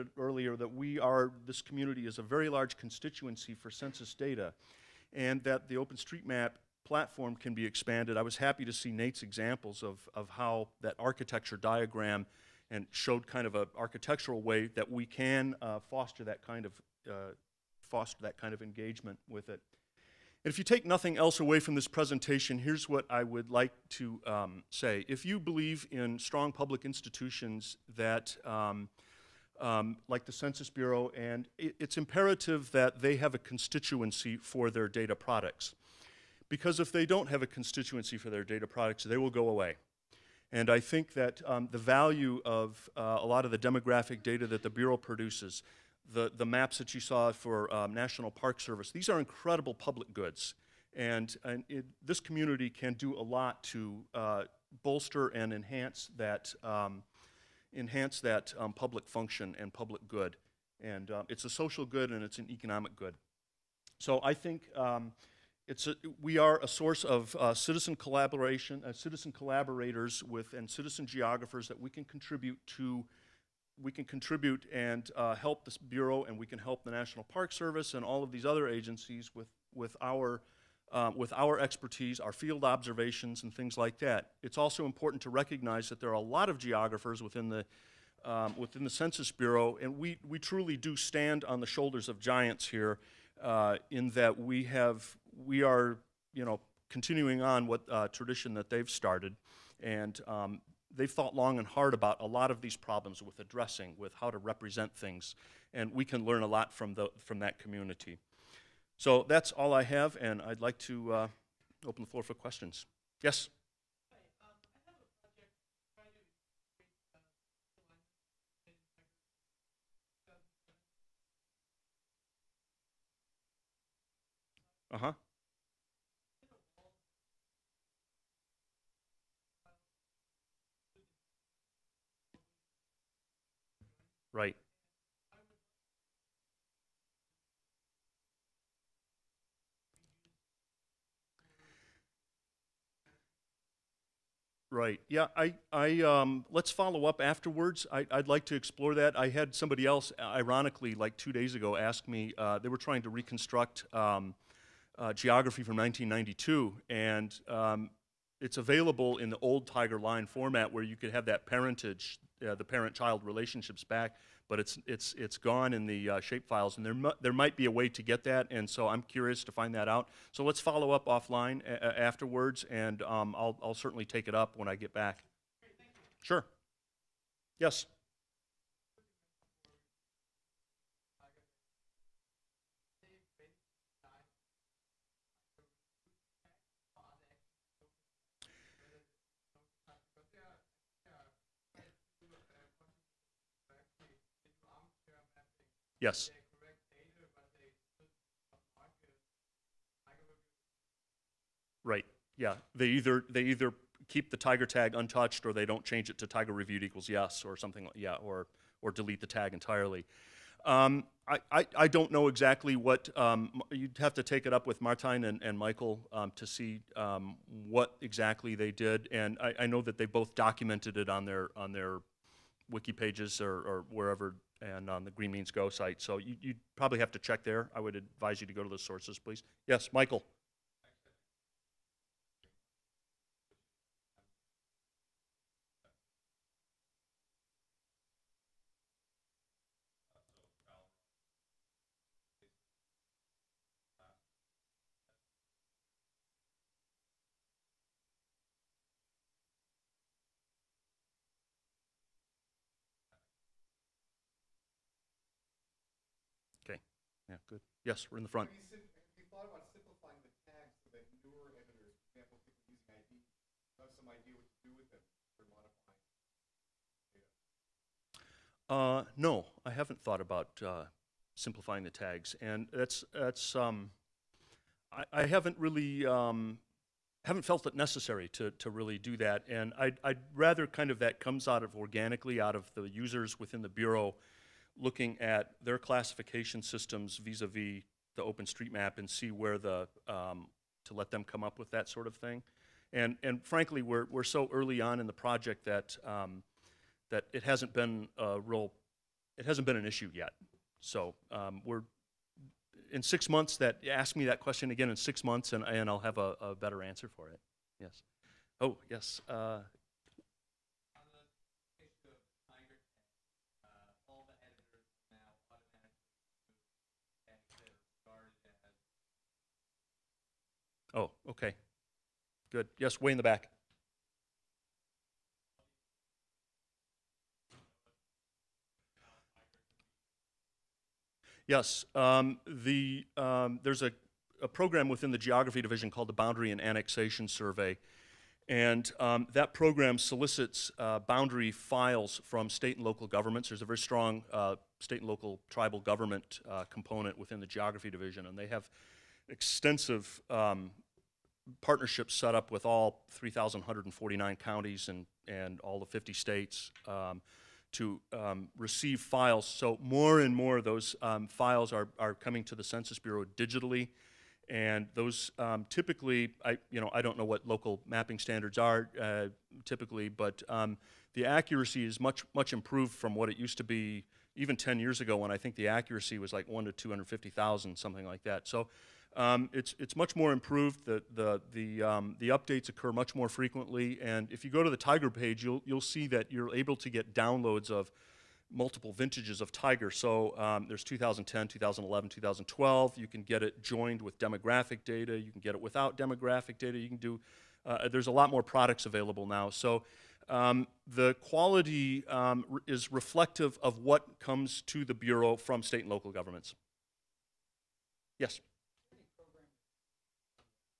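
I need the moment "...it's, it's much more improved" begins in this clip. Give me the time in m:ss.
6:19.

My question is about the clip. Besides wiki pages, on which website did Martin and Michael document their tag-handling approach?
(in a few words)
Green Means Go.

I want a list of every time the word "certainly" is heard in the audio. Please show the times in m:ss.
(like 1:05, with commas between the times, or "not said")
2:53.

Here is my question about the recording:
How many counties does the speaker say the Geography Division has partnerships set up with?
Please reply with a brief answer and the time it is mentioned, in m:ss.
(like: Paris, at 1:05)
3,149, at 5:53.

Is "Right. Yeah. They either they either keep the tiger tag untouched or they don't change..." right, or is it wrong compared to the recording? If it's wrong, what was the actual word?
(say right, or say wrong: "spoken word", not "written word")
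right.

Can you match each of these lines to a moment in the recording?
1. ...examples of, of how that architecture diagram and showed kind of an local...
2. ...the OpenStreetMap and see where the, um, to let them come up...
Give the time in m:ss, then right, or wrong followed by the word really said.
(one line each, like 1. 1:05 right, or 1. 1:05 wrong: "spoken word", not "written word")
1. 0:09 wrong: "architectural", not "local"
2. 4:48 right.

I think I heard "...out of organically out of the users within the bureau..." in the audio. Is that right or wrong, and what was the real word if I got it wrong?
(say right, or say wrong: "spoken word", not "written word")
right.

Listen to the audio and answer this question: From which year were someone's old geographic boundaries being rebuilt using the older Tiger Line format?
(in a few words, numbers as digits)
1992.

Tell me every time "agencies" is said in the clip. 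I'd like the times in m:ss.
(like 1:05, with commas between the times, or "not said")
1:18.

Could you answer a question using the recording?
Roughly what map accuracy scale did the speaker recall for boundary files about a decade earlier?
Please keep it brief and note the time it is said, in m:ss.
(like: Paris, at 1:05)
1 to 250,000, at 6:16.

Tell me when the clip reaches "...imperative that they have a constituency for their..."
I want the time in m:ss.
0:31.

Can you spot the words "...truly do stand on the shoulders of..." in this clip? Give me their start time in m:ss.
1:30.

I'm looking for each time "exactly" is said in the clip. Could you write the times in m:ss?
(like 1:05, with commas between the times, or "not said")
3:32, 3:38.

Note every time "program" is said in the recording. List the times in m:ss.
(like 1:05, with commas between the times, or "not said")
5:34, 5:39.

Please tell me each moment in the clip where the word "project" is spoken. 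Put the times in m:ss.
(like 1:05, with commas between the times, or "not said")
4:55.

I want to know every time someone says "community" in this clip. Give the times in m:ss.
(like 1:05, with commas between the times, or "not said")
0:01, 0:52, 1:47.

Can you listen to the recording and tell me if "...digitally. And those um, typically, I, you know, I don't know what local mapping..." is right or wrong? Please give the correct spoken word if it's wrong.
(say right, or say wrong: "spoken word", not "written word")
right.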